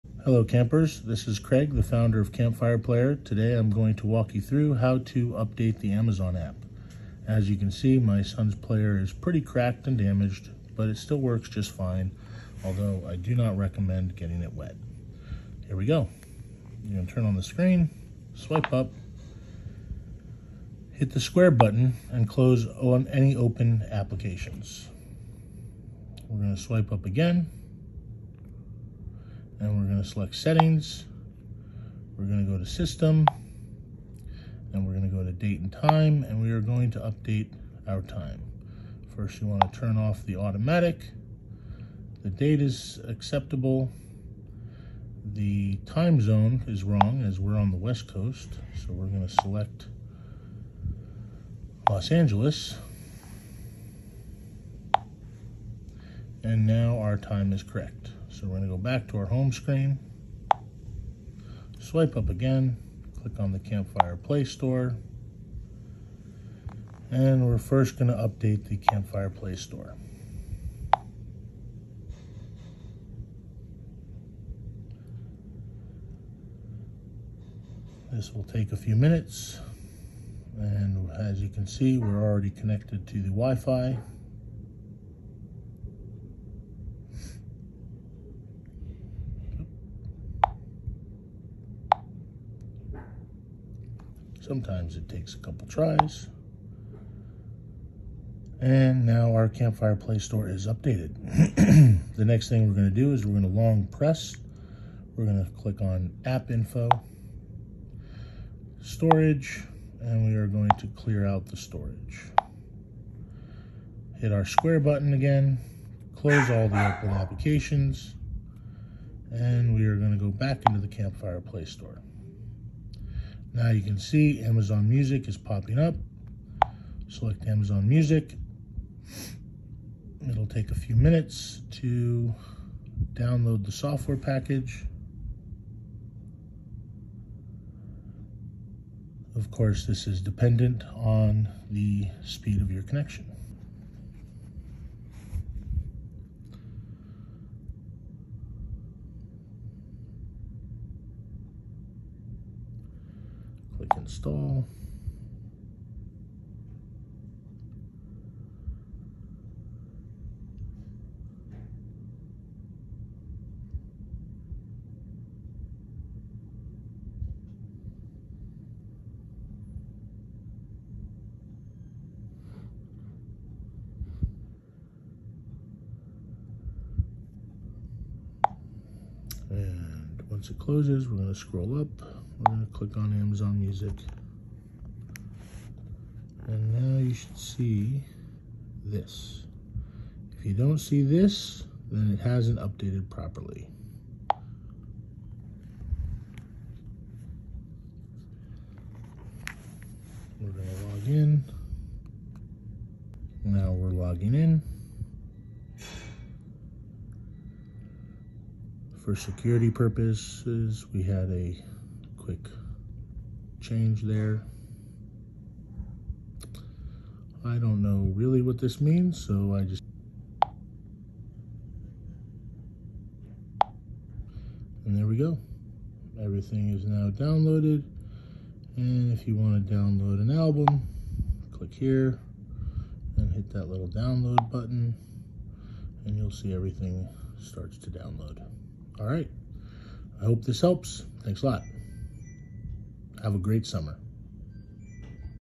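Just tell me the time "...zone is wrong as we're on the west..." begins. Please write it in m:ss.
0:46.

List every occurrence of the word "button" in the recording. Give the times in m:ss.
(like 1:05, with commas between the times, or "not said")
0:21, 1:54, 3:54.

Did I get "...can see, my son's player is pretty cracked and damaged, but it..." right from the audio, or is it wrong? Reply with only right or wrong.
right.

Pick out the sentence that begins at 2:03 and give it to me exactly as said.
Now you can see Amazon Music is popping up.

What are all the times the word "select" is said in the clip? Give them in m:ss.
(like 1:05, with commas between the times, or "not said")
0:30, 0:49, 2:07.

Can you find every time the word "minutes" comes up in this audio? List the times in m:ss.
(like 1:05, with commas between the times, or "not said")
1:18, 2:10.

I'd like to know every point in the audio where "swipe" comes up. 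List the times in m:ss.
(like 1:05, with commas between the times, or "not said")
0:18, 0:26, 1:01.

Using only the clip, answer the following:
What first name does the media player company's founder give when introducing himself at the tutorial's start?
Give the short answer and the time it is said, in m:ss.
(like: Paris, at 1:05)
Craig, at 0:01.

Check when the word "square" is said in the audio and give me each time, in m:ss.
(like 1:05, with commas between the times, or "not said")
0:21, 1:54.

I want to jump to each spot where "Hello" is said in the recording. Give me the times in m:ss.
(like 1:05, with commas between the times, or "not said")
0:00.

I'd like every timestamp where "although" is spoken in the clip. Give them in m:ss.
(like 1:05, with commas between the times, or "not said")
0:12.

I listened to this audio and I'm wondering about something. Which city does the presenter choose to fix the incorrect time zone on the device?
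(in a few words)
Los Angeles.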